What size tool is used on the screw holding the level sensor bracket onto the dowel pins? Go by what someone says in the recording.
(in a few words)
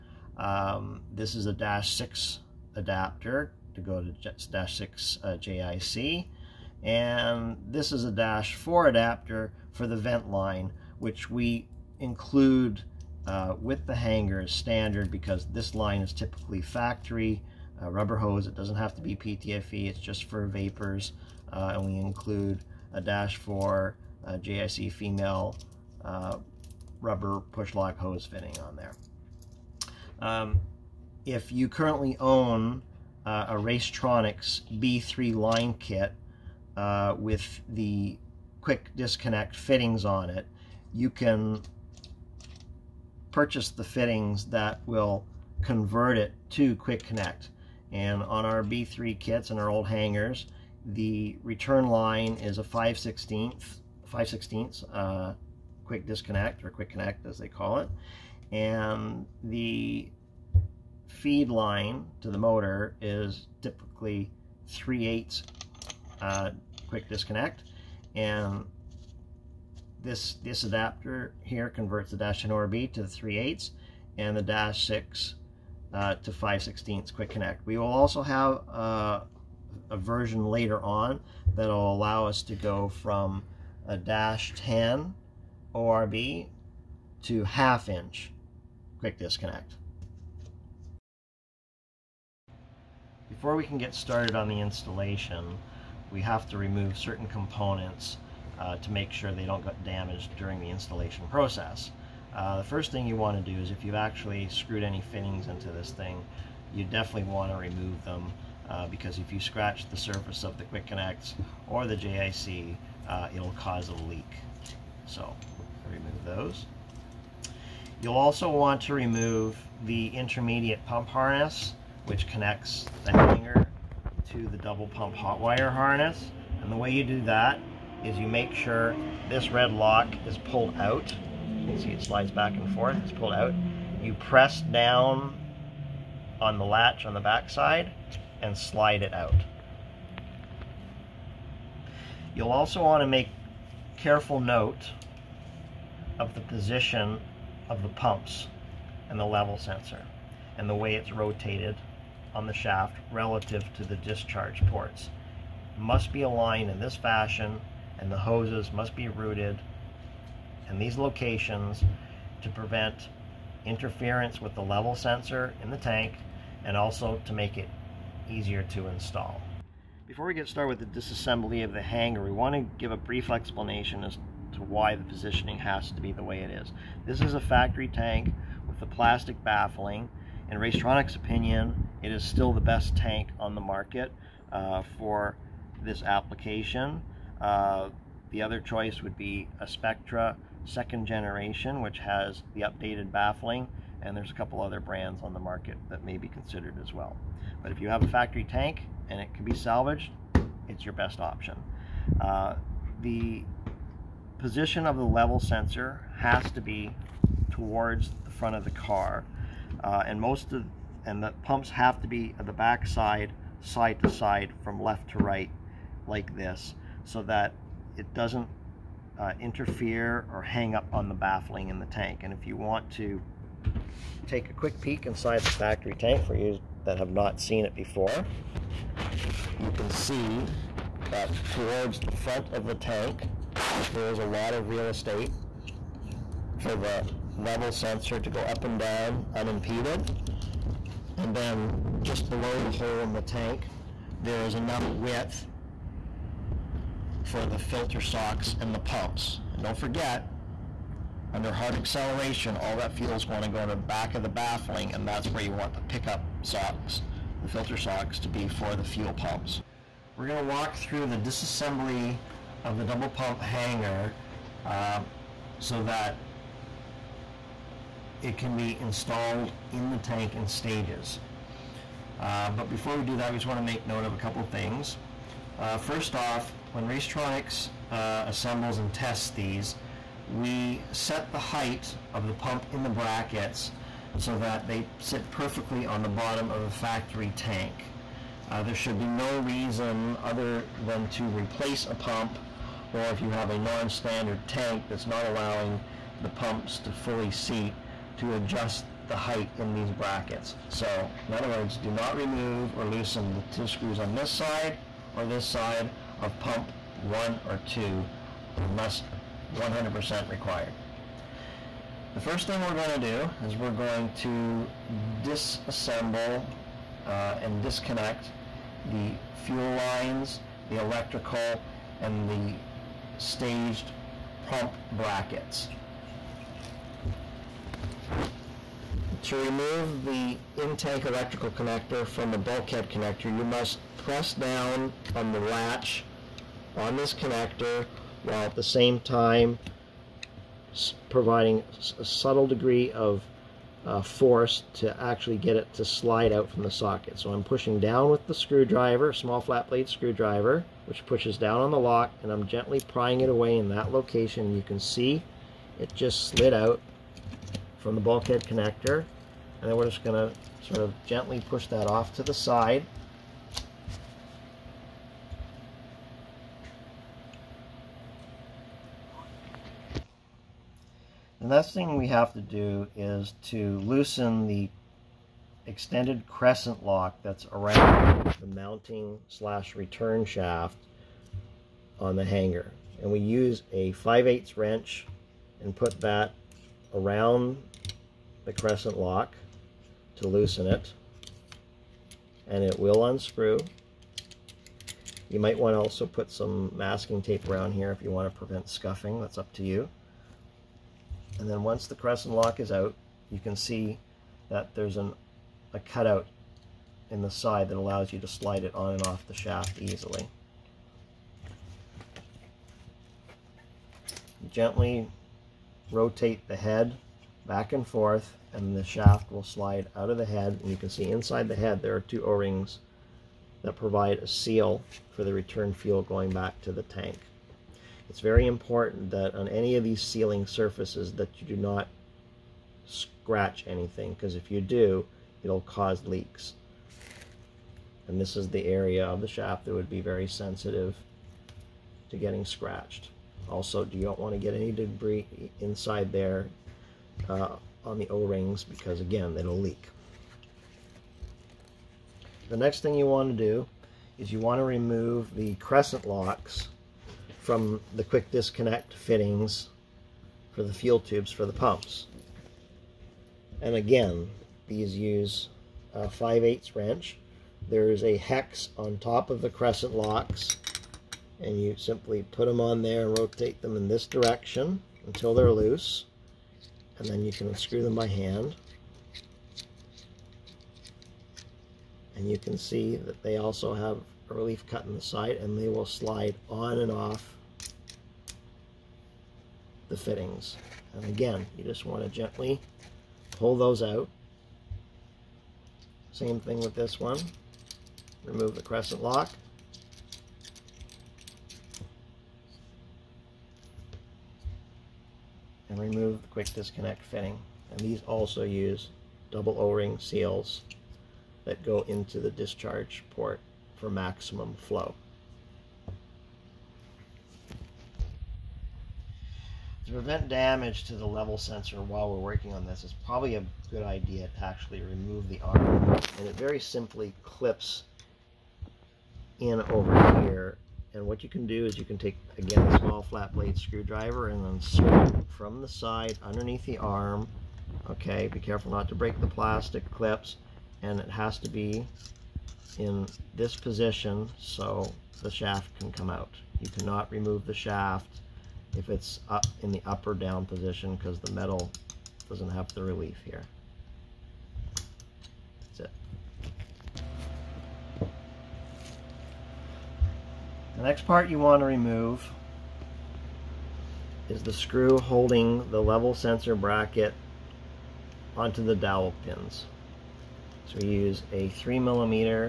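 3 millimeter.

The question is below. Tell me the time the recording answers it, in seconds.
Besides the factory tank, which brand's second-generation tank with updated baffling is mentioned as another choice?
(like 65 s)
189 s.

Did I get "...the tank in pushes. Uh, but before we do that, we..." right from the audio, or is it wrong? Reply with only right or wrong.
wrong.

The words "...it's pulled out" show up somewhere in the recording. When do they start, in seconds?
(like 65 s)
133 s.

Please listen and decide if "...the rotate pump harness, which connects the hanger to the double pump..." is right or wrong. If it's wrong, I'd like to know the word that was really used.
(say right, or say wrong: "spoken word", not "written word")
wrong: "intermediate", not "rotate".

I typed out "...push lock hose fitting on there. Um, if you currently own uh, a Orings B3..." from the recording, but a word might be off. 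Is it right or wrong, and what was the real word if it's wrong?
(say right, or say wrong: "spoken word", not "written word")
wrong: "Racetronix", not "Orings".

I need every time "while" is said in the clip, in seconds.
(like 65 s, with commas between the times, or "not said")
338 s, 521 s.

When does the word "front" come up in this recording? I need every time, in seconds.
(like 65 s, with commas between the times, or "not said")
208 s, 232 s.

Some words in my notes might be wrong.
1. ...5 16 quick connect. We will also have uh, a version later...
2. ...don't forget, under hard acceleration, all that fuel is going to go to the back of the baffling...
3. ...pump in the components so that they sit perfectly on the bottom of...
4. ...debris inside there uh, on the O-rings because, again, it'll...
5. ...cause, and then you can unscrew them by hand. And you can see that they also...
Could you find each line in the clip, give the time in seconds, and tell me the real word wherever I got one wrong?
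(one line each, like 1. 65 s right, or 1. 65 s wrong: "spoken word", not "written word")
1. 76 s right
2. 249 s right
3. 282 s wrong: "brackets", not "components"
4. 444 s right
5. 475 s wrong: "loose", not "cause".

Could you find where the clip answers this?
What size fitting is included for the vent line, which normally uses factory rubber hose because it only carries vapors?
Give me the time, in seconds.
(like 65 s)
8 s.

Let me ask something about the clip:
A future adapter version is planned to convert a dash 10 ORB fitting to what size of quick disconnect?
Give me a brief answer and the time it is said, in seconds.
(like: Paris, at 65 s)
half inch, at 87 s.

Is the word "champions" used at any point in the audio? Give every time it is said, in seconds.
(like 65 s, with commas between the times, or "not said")
not said.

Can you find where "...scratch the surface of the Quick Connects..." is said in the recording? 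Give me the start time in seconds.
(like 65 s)
109 s.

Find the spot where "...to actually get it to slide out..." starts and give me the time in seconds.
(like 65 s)
344 s.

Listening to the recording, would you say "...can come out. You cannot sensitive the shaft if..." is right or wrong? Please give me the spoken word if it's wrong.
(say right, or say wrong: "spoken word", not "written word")
wrong: "remove", not "sensitive".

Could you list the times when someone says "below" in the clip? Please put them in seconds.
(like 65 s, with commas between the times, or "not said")
242 s.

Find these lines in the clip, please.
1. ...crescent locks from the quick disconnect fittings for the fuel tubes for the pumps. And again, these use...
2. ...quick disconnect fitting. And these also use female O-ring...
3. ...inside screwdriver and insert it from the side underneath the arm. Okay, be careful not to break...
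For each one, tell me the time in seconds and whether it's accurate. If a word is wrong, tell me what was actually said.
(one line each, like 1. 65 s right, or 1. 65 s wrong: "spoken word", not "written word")
1. 455 s right
2. 506 s wrong: "double", not "female"
3. 533 s wrong: "blade", not "inside".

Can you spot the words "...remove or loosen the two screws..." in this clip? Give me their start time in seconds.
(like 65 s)
302 s.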